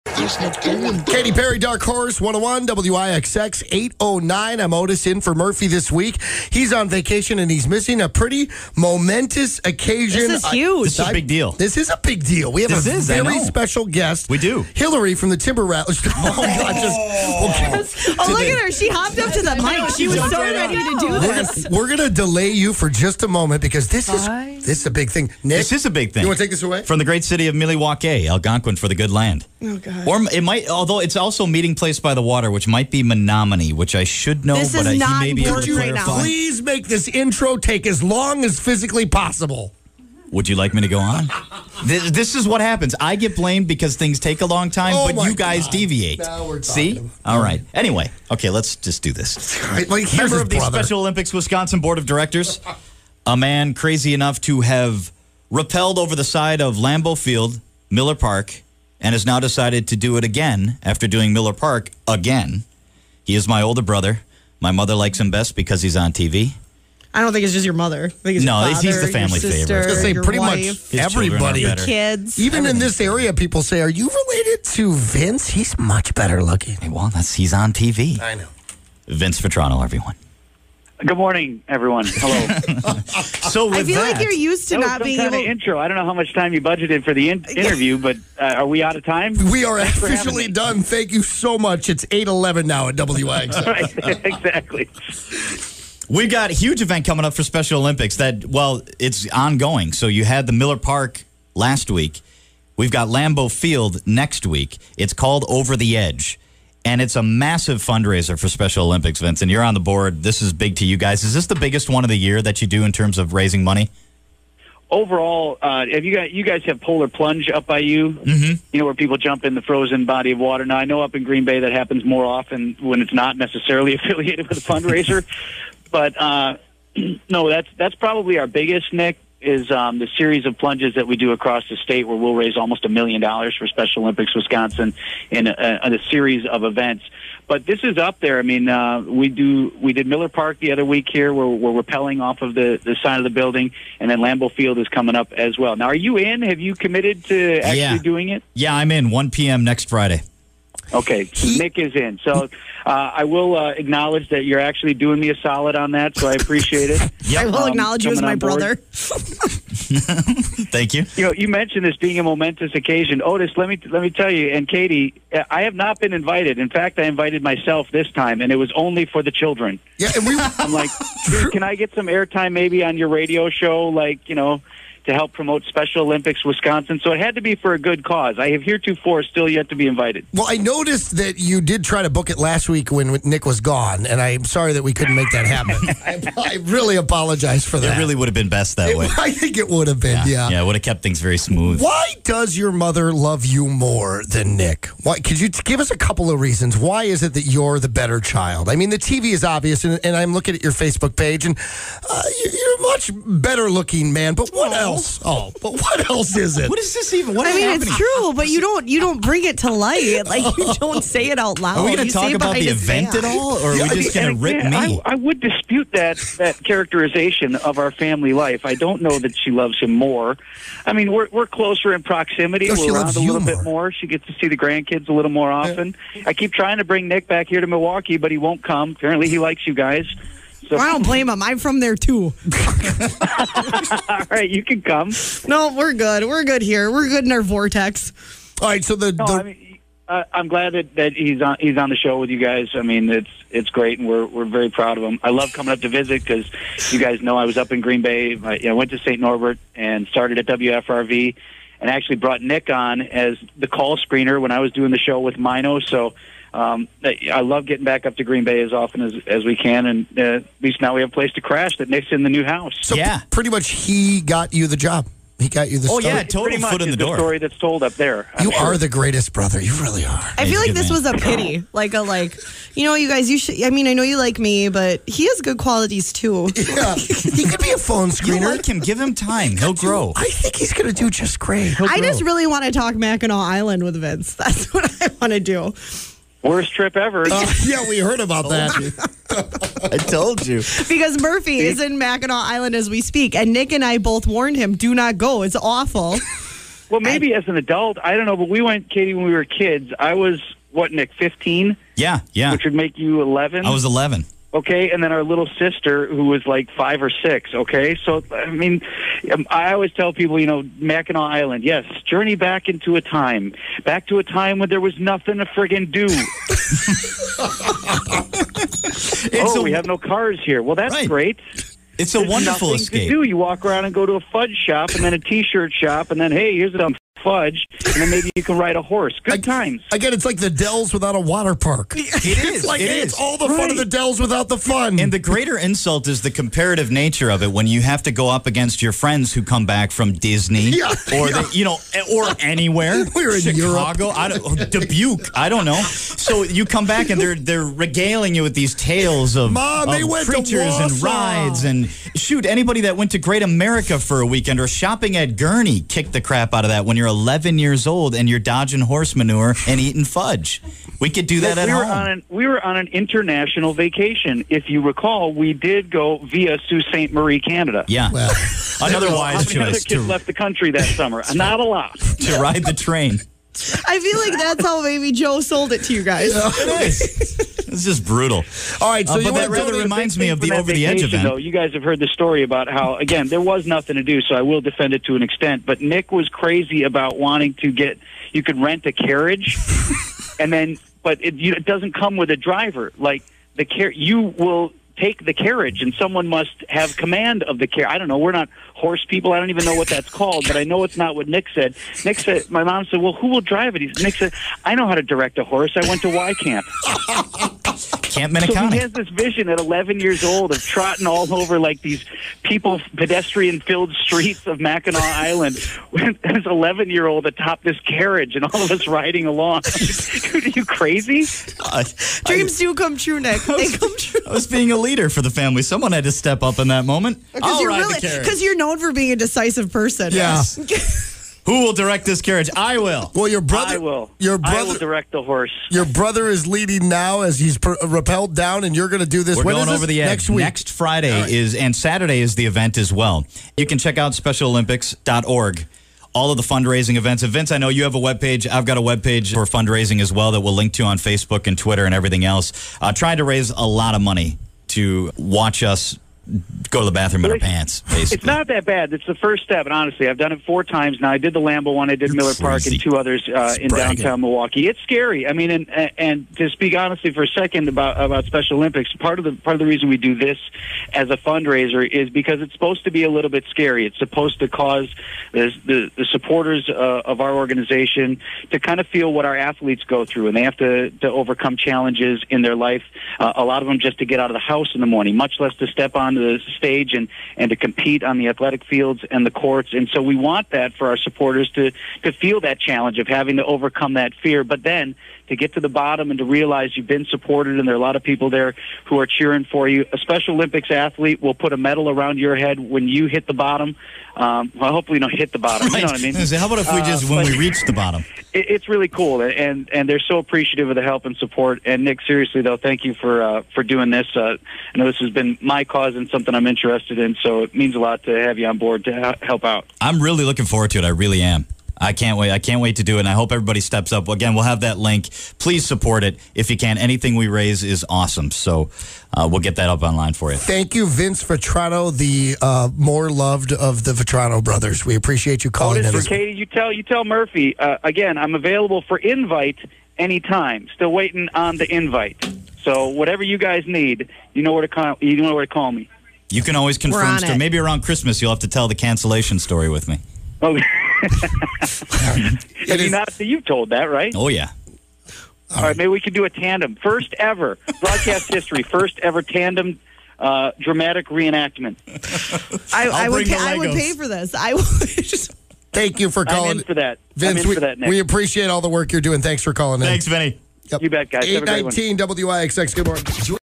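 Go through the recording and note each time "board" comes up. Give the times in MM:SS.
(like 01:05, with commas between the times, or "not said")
00:51, 01:49, 08:38.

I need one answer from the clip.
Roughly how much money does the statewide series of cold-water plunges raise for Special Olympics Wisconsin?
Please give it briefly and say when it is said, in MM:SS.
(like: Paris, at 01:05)
almost a million dollars, at 02:12.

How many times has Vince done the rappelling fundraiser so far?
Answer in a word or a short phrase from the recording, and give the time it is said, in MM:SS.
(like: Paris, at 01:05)
4, at 07:40.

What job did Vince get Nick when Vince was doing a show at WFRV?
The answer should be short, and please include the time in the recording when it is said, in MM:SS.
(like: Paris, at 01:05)
call screener, at 04:13.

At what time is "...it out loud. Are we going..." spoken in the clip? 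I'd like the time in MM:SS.
03:31.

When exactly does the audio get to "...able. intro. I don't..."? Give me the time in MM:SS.
01:25.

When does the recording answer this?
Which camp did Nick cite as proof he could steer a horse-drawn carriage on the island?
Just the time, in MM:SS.
06:48.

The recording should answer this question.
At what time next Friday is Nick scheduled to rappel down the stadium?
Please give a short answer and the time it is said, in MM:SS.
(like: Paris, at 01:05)
1 p.m., at 02:29.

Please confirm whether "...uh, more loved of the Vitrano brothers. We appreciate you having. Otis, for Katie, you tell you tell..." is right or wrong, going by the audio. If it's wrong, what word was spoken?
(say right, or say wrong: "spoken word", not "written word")
wrong: "calling", not "having".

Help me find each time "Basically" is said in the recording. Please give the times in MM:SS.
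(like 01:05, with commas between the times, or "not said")
07:37.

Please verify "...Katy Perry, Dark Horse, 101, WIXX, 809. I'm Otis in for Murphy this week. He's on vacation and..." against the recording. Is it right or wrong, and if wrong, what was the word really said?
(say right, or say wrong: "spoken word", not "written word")
right.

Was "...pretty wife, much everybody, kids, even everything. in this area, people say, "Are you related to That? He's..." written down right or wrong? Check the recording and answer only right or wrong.
wrong.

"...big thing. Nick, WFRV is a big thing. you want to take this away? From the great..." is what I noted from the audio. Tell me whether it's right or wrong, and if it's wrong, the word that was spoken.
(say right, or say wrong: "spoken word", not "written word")
wrong: "This", not "WFRV".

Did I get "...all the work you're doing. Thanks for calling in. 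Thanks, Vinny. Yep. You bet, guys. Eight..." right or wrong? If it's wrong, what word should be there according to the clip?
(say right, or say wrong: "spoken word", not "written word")
right.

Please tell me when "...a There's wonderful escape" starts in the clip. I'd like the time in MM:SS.
05:22.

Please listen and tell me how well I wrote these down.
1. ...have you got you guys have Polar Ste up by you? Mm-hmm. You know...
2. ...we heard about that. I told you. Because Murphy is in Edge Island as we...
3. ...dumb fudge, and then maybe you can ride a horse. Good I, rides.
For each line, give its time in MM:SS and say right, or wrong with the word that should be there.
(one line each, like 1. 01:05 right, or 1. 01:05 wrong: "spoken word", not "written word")
1. 01:55 wrong: "Plunge", not "Ste"
2. 04:47 wrong: "Mackinac", not "Edge"
3. 05:26 wrong: "times", not "rides".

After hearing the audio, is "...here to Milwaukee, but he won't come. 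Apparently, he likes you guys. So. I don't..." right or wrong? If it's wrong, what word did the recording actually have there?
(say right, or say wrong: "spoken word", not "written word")
right.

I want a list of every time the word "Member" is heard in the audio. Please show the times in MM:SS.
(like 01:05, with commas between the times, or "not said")
00:50.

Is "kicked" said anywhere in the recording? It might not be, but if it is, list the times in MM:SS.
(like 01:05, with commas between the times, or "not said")
05:55.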